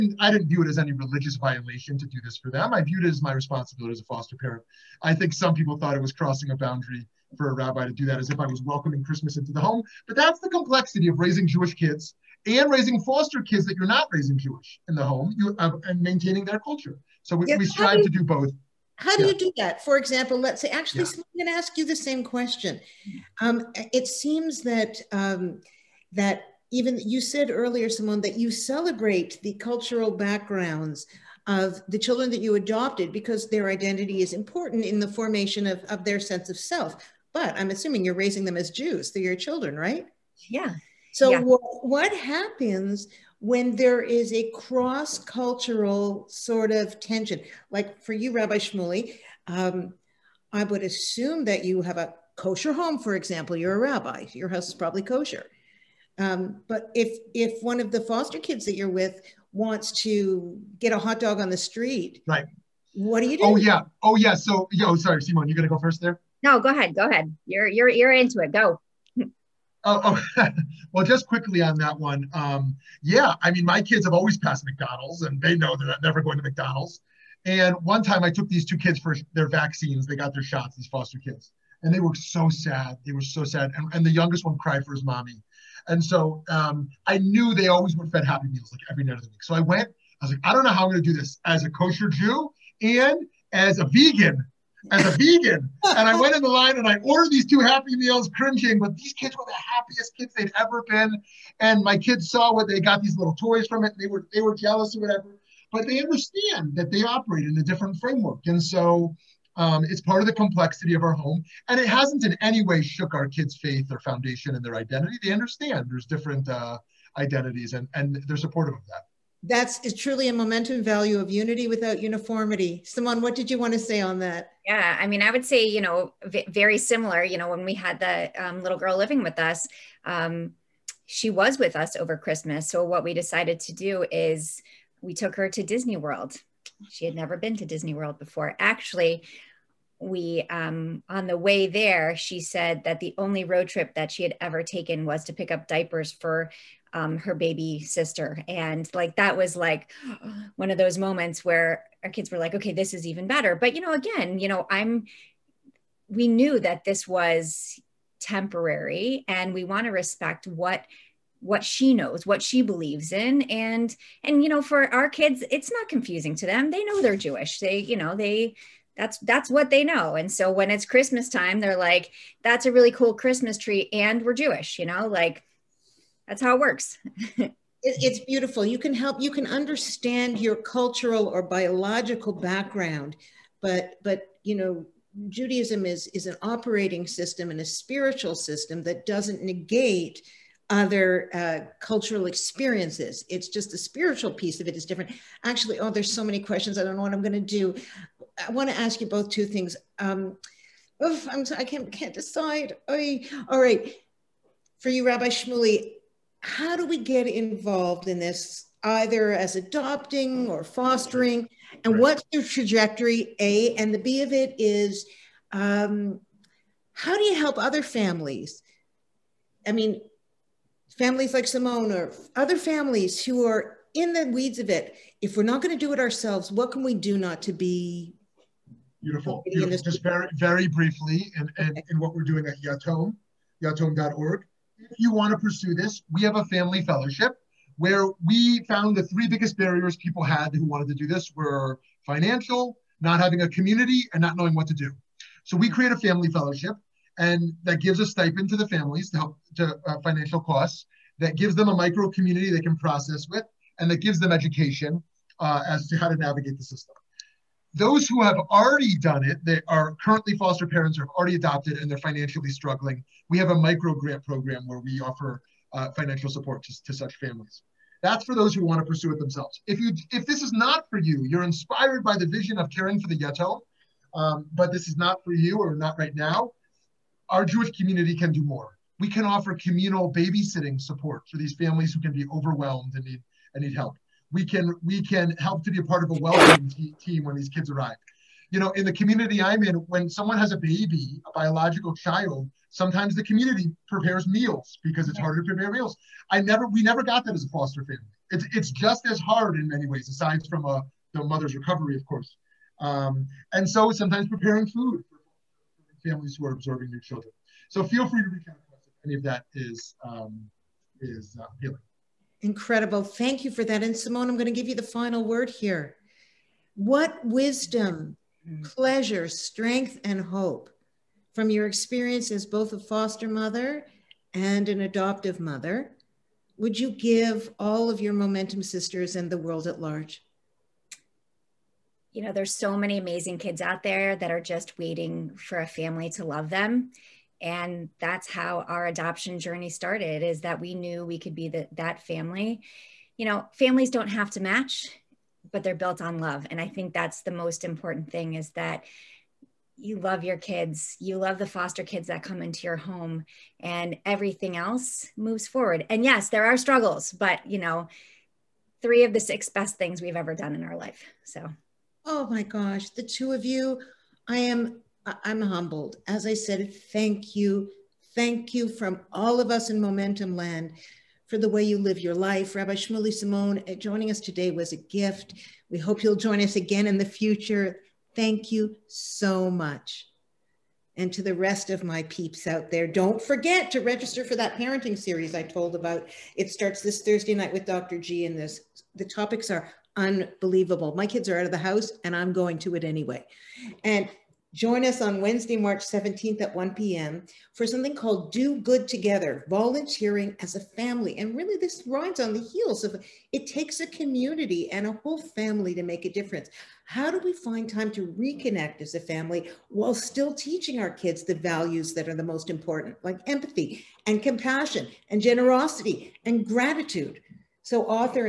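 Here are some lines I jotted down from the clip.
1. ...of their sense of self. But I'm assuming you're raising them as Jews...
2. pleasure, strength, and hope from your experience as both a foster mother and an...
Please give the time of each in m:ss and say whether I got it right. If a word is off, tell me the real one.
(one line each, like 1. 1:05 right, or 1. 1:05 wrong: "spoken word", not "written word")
1. 0:35 right
2. 5:18 right.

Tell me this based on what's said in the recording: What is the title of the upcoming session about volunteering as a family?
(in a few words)
Do Good Together.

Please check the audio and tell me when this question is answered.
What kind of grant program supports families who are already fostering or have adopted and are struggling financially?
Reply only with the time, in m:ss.
4:23.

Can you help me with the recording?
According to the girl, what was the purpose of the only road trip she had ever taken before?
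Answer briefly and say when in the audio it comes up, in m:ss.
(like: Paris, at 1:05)
To pick up diapers, at 2:25.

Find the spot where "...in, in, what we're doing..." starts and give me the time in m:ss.
3:51.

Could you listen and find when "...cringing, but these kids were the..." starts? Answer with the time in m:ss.
1:38.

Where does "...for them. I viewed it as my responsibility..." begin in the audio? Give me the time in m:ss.
0:02.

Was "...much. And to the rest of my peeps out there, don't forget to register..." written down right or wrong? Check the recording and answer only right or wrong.
right.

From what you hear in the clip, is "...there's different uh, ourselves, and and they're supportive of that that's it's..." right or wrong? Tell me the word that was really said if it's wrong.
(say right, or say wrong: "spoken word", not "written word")
wrong: "identities", not "ourselves".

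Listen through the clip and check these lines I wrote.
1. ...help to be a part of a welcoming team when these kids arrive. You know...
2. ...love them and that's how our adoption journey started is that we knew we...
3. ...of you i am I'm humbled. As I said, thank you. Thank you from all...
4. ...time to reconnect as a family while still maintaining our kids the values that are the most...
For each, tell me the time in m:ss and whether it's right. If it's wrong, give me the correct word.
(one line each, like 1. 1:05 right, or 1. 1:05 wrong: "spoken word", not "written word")
1. 4:45 right
2. 5:36 right
3. 6:03 right
4. 6:47 wrong: "teaching", not "maintaining".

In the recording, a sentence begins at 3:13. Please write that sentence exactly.
It's just the spiritual piece of it is different.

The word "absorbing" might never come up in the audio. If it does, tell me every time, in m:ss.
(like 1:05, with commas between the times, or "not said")
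5:06.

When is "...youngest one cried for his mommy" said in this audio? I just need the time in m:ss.
1:24.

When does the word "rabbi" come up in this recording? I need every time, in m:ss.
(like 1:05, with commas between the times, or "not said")
0:07, 0:48, 0:53, 3:25, 6:12.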